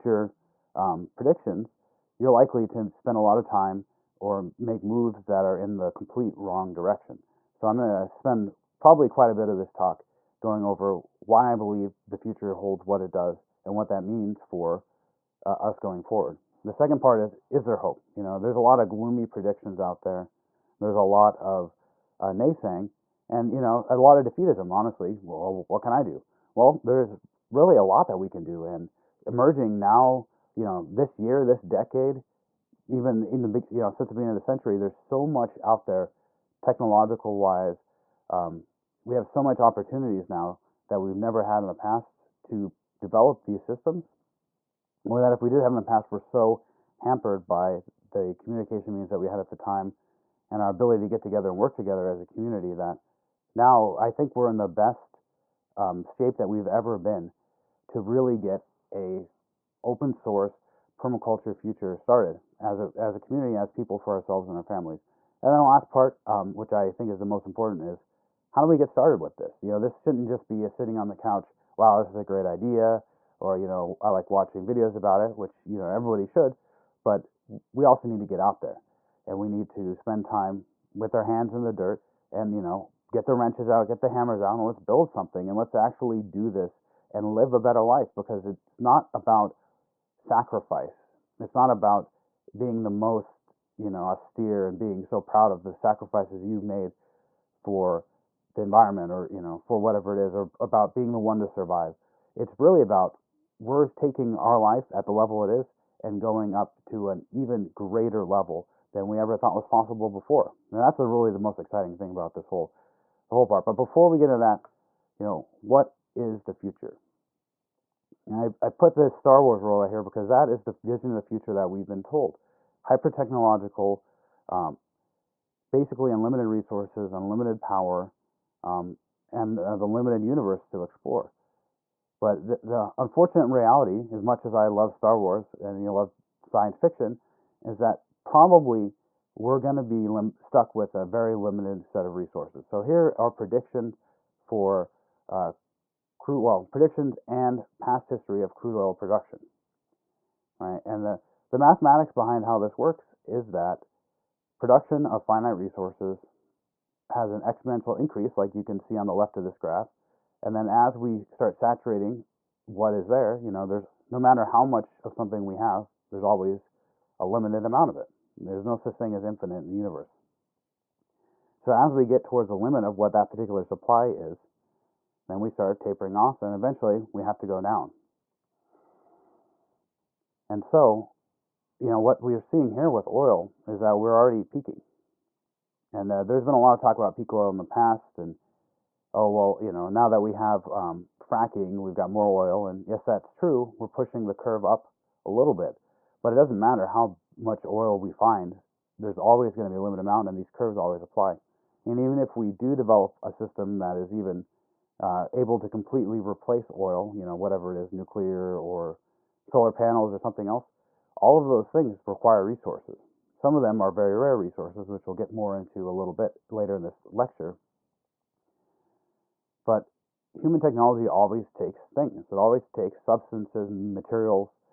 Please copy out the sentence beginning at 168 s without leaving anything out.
There's no such thing as infinite in the universe.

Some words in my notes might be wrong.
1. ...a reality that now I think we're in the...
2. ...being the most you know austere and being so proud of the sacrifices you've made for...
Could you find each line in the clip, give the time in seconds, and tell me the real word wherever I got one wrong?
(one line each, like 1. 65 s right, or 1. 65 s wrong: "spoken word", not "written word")
1. 52 s wrong: "community", not "reality"
2. 92 s right.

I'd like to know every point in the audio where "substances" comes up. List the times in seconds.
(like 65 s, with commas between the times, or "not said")
223 s.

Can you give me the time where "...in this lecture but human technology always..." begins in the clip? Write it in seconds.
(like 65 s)
216 s.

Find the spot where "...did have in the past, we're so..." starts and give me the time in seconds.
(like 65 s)
45 s.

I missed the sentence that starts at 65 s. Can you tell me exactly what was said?
And then the last part, um, which I think is the most important, is how do we get started with this?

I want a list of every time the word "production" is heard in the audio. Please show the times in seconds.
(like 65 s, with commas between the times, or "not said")
148 s, 154 s.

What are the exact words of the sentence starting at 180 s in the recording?
And so, you know, what we're seeing here with oil is that we're already peaking.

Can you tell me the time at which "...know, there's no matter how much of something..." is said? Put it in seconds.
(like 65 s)
163 s.